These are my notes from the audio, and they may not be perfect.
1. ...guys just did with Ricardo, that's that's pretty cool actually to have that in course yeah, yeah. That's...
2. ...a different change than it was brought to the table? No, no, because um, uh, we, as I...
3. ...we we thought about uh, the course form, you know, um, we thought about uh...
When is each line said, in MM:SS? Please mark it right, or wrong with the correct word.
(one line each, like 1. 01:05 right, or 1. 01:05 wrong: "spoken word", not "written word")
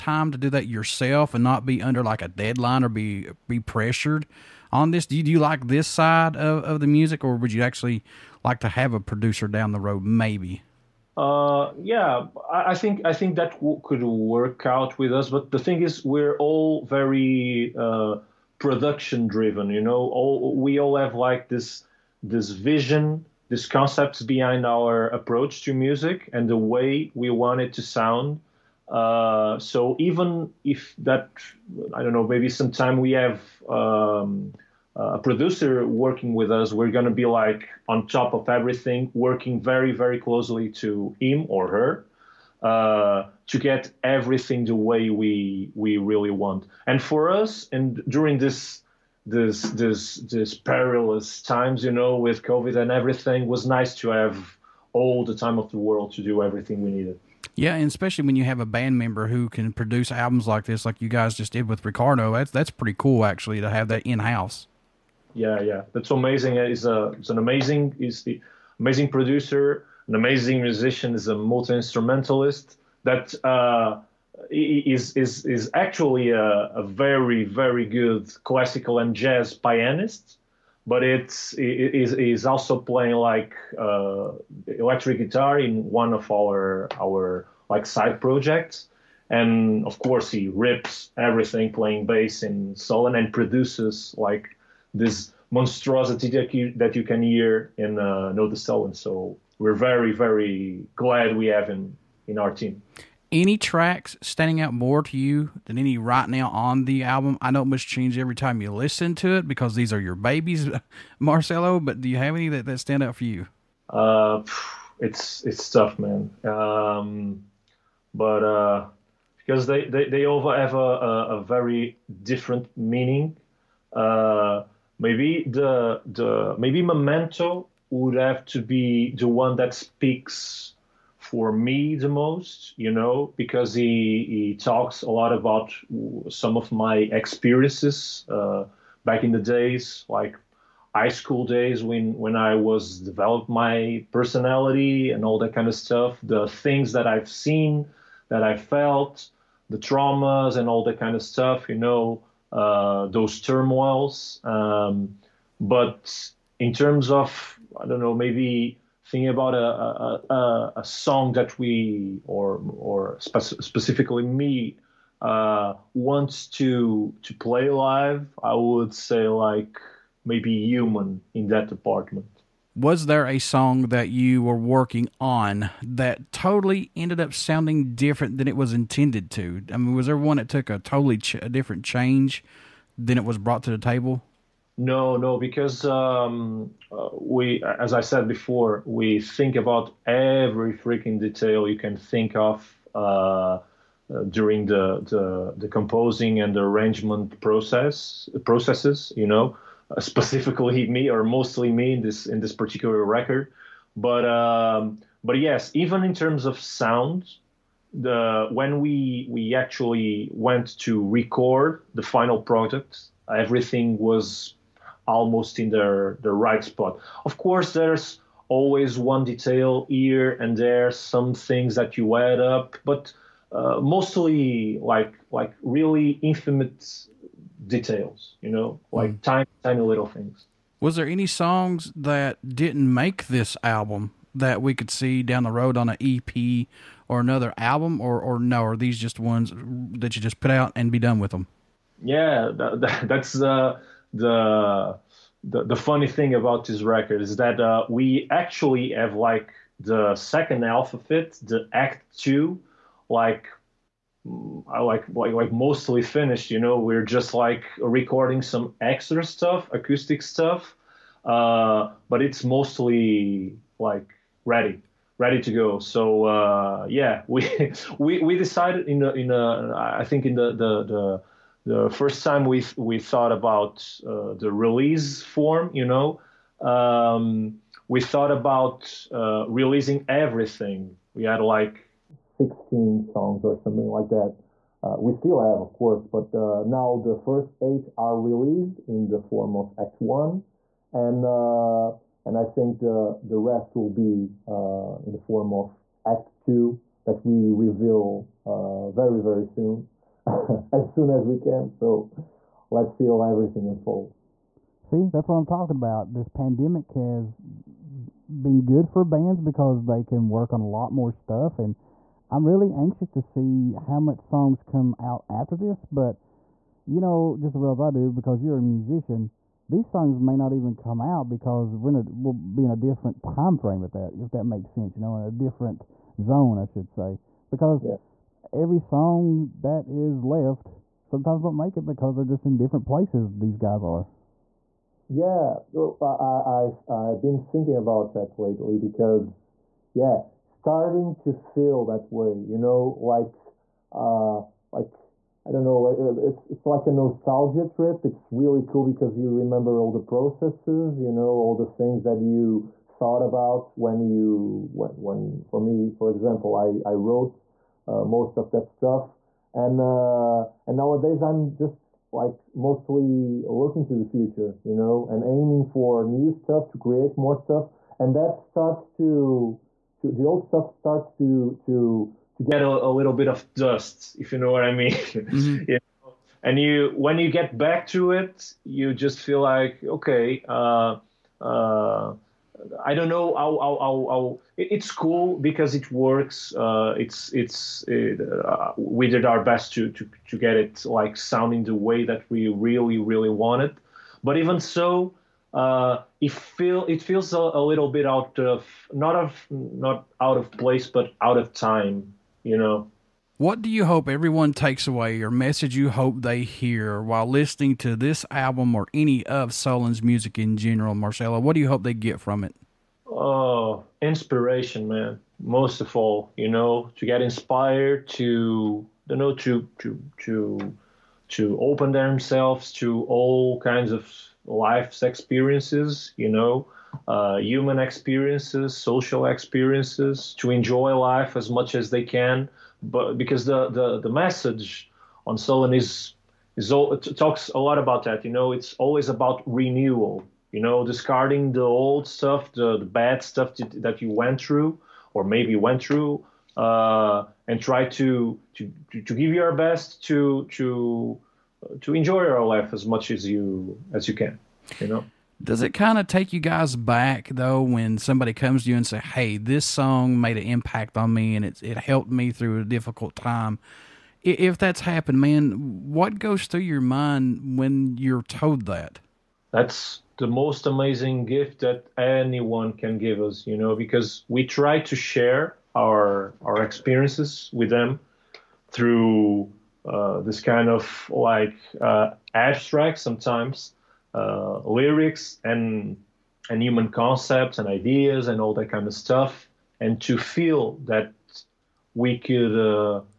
1. 01:01 wrong: "house", not "course"
2. 03:01 right
3. 04:32 wrong: "release", not "course".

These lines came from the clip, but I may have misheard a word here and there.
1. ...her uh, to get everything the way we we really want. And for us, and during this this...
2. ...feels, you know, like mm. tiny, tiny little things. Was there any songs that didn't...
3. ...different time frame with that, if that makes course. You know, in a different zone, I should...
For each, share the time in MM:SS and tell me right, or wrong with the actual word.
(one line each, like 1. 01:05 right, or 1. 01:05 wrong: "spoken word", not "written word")
1. 00:41 right
2. 03:47 wrong: "details", not "feels"
3. 05:22 wrong: "sense", not "course".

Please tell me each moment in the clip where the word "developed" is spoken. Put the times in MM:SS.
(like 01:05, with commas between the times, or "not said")
02:22.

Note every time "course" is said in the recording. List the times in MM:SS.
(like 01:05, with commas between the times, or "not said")
01:29, 03:37, 04:45.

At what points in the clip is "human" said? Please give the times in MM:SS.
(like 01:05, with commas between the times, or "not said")
02:50, 07:07, 08:06.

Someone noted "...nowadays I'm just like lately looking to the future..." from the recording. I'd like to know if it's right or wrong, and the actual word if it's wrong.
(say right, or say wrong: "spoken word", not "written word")
wrong: "mostly", not "lately".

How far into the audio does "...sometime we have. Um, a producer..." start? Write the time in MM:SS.
00:32.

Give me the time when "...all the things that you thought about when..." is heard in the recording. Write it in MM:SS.
05:51.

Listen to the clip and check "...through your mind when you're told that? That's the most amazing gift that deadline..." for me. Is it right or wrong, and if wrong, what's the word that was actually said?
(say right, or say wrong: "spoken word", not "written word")
wrong: "anyone", not "deadline".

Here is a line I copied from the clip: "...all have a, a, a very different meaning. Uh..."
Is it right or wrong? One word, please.
right.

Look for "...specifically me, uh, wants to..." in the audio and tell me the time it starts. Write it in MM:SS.
02:43.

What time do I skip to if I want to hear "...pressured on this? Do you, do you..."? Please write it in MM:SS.
00:03.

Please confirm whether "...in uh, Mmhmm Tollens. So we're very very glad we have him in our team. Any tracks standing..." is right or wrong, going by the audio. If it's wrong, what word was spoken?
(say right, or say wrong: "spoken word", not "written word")
wrong: "Nodus", not "Mmhmm".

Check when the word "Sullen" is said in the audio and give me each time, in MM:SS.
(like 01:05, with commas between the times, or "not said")
06:49, 07:15.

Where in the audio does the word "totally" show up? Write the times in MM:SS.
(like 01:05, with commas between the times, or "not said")
02:56, 03:00.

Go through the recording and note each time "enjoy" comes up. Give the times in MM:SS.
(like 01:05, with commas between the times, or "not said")
07:10, 07:31.